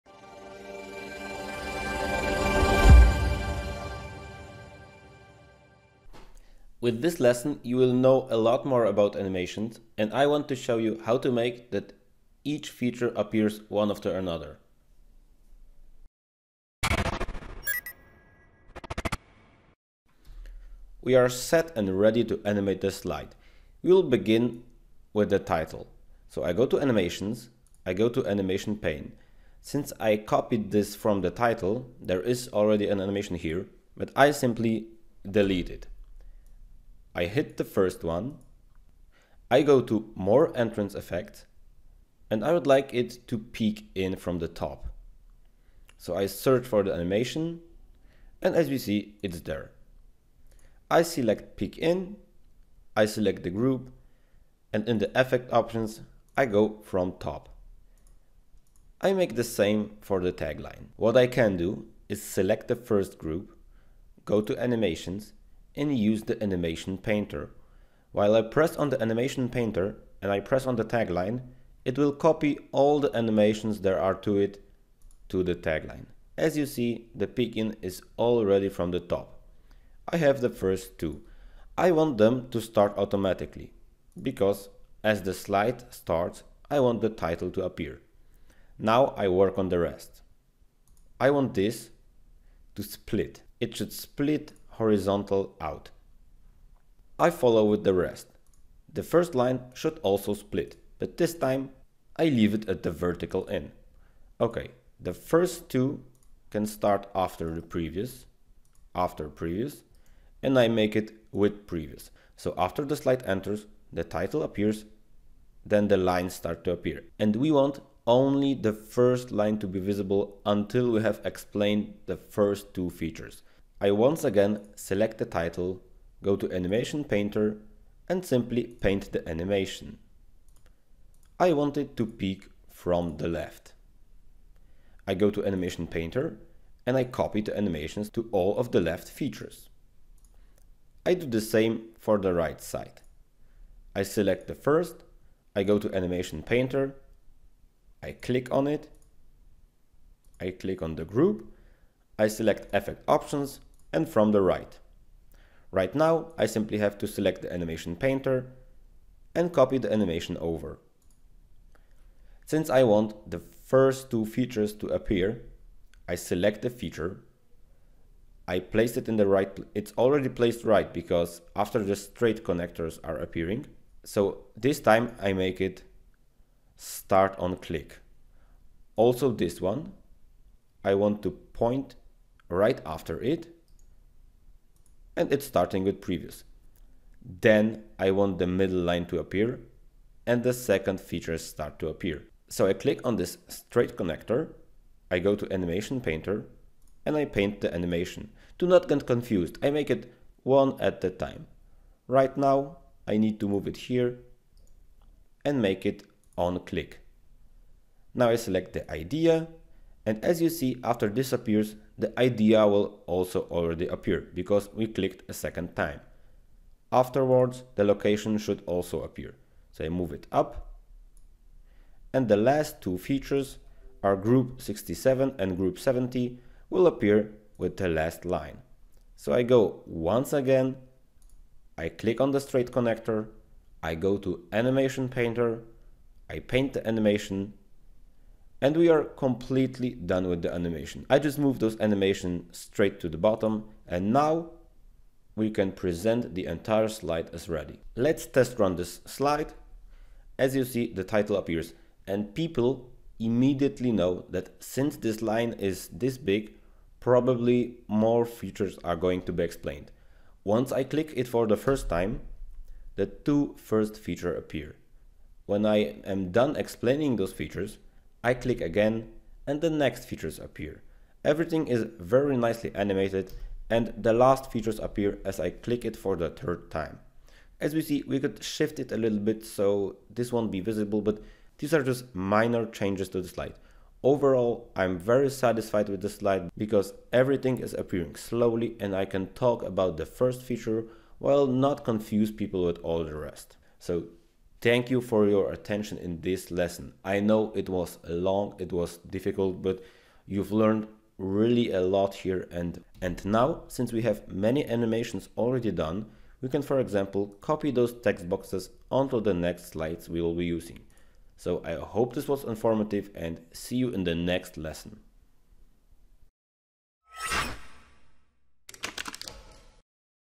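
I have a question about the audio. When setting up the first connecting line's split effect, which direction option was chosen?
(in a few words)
Vertical in.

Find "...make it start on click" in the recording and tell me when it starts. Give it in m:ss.
2:55.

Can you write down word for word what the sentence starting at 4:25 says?
When I am done explaining those features, I click again and the next features appear.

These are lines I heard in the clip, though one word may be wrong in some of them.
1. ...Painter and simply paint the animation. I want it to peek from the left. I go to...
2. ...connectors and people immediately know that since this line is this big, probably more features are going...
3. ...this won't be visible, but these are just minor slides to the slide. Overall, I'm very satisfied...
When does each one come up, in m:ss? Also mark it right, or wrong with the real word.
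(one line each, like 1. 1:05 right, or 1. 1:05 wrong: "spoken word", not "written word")
1. 2:07 right
2. 4:11 wrong: "appears", not "connectors"
3. 4:40 wrong: "changes", not "slides".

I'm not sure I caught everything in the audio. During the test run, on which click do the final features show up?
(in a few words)
Third.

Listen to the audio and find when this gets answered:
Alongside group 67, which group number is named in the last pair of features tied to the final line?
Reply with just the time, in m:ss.
3:45.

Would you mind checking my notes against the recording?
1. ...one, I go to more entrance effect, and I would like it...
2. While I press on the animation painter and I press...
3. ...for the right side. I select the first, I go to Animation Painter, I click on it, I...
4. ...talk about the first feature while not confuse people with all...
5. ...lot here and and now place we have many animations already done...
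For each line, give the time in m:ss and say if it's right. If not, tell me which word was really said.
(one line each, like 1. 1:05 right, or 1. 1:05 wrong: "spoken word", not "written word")
1. 0:38 right
2. 1:08 right
3. 2:21 right
4. 4:49 right
5. 5:01 wrong: "since", not "place".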